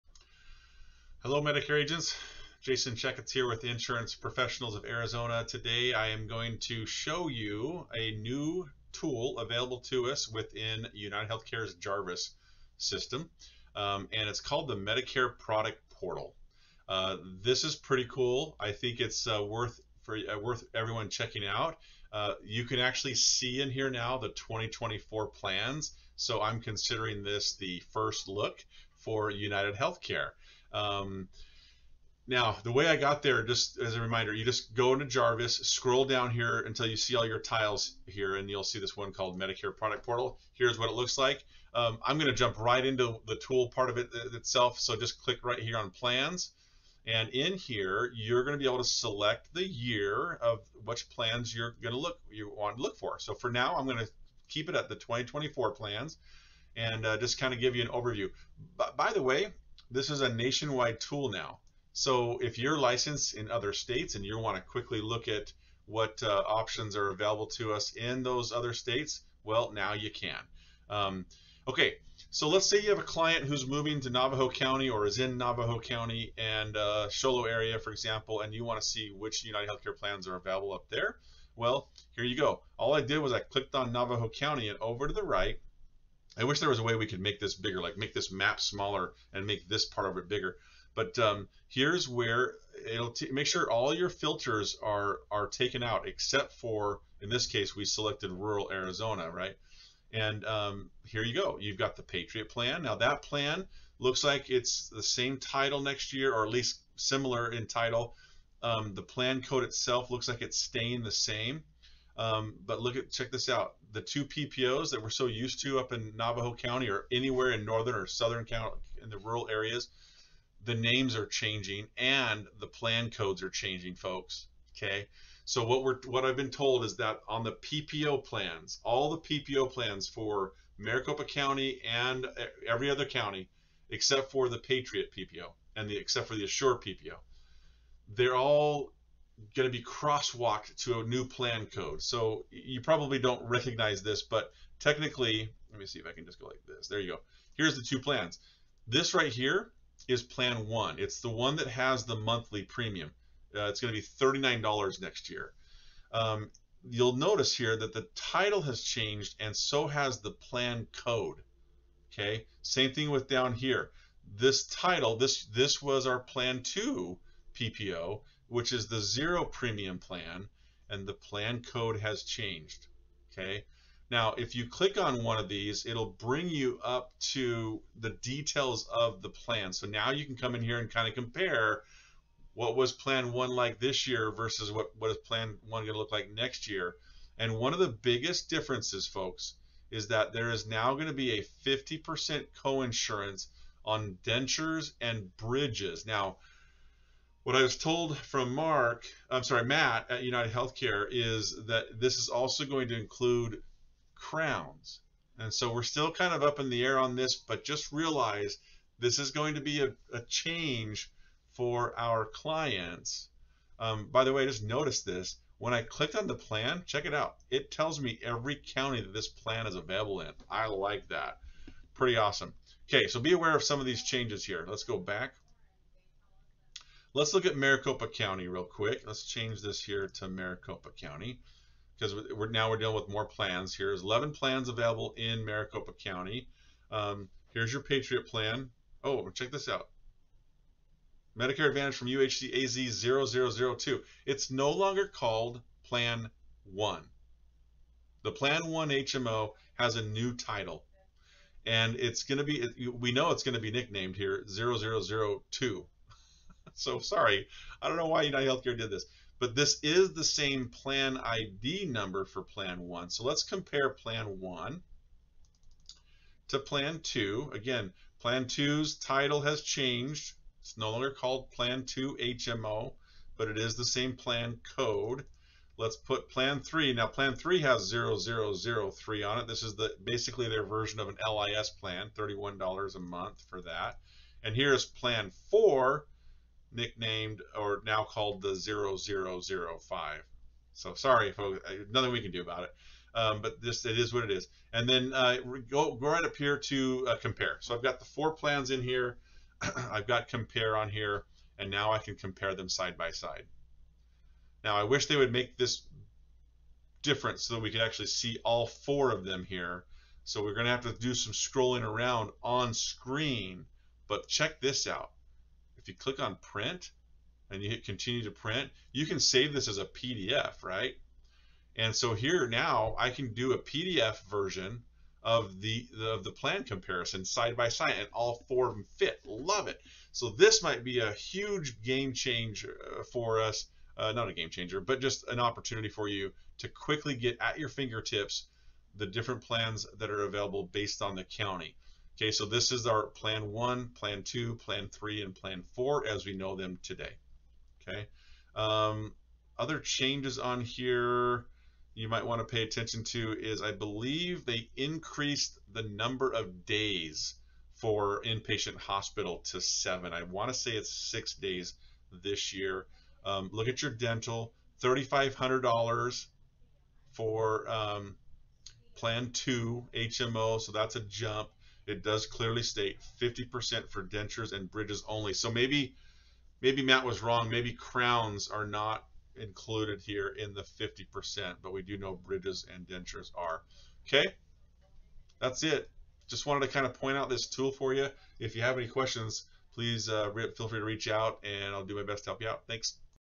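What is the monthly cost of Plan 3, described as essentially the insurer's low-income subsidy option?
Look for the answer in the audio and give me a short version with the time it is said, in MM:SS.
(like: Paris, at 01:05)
$31, at 04:42.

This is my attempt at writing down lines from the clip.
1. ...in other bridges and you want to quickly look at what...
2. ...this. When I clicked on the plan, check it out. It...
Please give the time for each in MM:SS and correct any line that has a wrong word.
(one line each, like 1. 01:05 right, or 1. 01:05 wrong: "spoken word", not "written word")
1. 01:03 wrong: "states", not "bridges"
2. 03:35 right.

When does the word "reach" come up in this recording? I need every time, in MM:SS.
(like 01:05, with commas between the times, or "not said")
06:30.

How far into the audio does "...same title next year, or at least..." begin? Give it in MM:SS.
01:45.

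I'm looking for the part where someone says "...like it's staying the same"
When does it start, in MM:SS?
01:50.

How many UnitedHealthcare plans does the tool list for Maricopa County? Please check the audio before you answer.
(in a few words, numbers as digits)
11.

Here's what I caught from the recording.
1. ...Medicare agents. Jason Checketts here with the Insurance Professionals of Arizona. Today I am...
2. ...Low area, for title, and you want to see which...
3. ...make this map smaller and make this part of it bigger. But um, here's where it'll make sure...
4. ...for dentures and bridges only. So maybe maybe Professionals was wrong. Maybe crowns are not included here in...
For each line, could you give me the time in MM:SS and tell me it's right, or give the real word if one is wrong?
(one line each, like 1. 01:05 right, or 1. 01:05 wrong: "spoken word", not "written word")
1. 00:01 right
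2. 01:17 wrong: "example", not "title"
3. 01:27 right
4. 06:13 wrong: "Matt", not "Professionals".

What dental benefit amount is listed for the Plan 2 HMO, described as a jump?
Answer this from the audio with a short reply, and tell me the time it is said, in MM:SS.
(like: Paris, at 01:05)
$3,500, at 06:04.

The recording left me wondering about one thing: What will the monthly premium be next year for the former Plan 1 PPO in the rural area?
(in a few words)
$39.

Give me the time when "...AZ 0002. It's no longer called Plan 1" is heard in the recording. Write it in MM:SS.
04:02.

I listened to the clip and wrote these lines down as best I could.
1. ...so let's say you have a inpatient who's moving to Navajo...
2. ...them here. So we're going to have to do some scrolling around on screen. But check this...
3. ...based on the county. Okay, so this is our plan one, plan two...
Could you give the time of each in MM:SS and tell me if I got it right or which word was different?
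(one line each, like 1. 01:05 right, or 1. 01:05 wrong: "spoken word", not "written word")
1. 01:12 wrong: "client", not "inpatient"
2. 05:09 right
3. 05:40 right.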